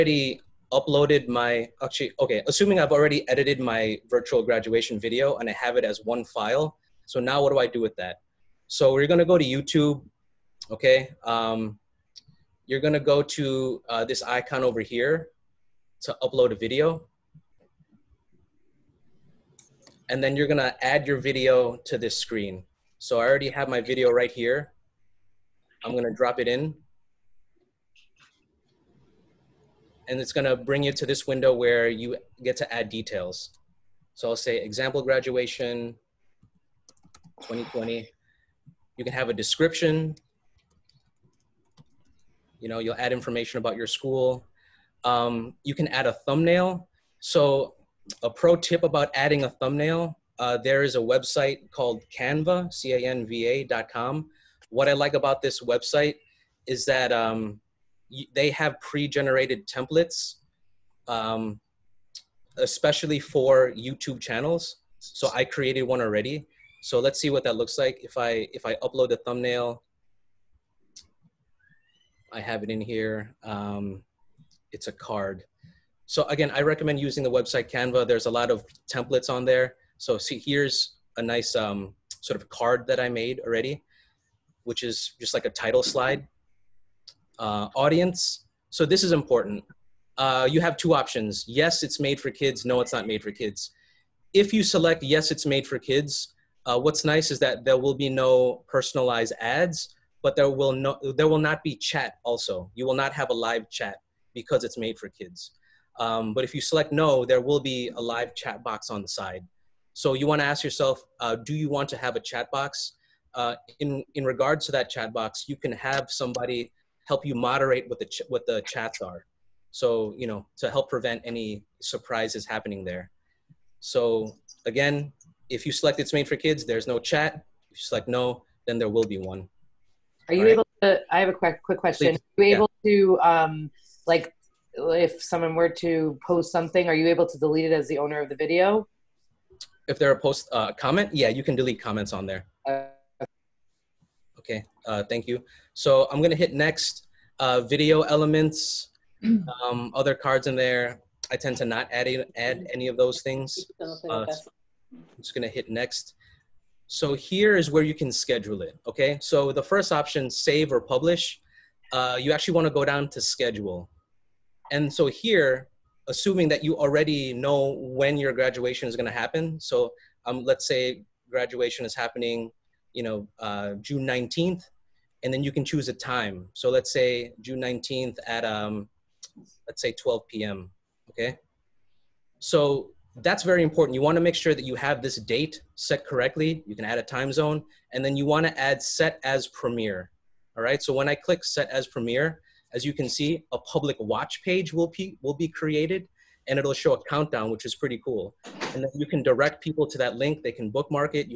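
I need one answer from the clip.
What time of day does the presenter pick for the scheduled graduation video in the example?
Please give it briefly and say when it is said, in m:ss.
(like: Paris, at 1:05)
12 p.m., at 2:59.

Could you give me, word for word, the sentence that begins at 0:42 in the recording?
You know, you'll add information about your school.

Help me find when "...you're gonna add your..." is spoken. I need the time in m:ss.
0:20.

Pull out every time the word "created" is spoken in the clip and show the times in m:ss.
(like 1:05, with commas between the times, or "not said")
1:05, 3:15.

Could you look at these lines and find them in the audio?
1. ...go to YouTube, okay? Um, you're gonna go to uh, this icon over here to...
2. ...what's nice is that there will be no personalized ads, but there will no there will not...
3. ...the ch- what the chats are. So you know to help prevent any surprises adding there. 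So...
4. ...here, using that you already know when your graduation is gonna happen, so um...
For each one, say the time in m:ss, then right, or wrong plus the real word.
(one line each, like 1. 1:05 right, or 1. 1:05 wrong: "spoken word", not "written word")
1. 0:09 right
2. 1:36 right
3. 1:57 wrong: "happening", not "adding"
4. 2:45 wrong: "assuming", not "using".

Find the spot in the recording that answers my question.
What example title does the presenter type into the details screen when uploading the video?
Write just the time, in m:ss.
0:34.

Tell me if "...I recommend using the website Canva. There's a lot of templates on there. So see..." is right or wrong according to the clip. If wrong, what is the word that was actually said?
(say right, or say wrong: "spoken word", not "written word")
right.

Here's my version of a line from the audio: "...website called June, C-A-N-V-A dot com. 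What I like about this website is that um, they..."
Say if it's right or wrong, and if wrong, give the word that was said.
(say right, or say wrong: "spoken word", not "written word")
wrong: "Canva", not "June".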